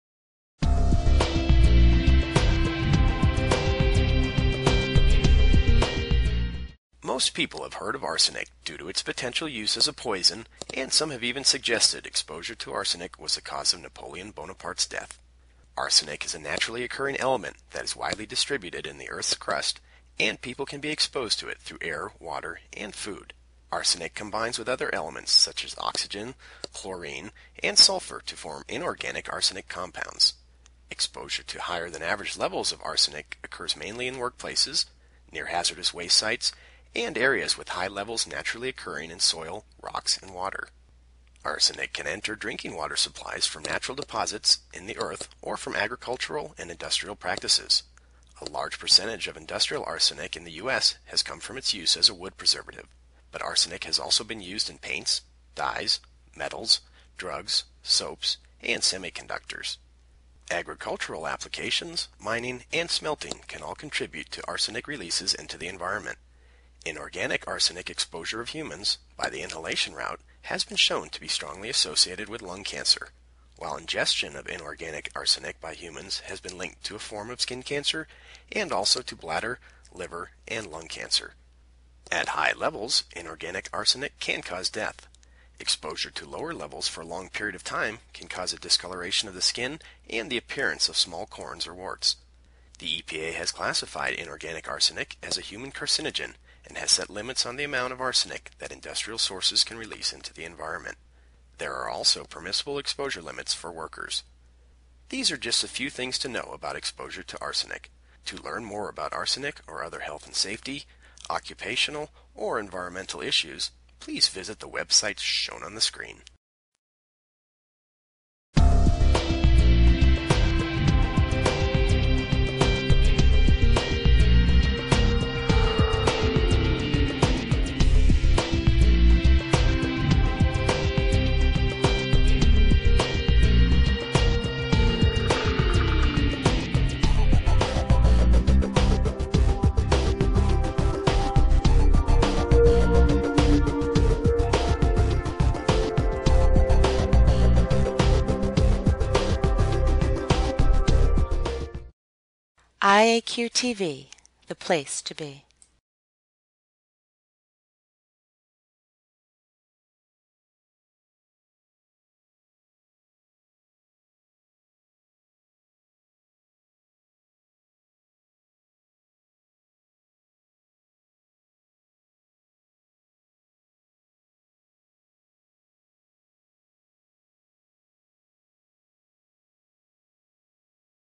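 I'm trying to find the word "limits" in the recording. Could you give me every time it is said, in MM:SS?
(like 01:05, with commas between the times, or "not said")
01:37, 01:43.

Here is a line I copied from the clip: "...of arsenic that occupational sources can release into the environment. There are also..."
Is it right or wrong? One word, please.
wrong.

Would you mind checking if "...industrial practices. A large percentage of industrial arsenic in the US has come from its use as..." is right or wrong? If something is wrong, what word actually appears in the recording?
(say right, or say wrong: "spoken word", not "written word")
right.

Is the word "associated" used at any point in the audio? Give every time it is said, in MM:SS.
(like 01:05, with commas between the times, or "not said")
01:11.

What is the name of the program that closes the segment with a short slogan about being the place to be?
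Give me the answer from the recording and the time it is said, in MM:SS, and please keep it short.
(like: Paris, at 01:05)
IAQ TV, at 02:32.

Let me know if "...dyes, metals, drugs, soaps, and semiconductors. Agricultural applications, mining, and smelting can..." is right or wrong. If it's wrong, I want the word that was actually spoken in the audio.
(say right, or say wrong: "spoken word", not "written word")
right.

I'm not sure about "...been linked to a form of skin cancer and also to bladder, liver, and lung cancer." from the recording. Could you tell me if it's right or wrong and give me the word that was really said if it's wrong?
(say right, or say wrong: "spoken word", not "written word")
right.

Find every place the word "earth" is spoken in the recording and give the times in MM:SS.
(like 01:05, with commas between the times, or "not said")
00:19, 00:44.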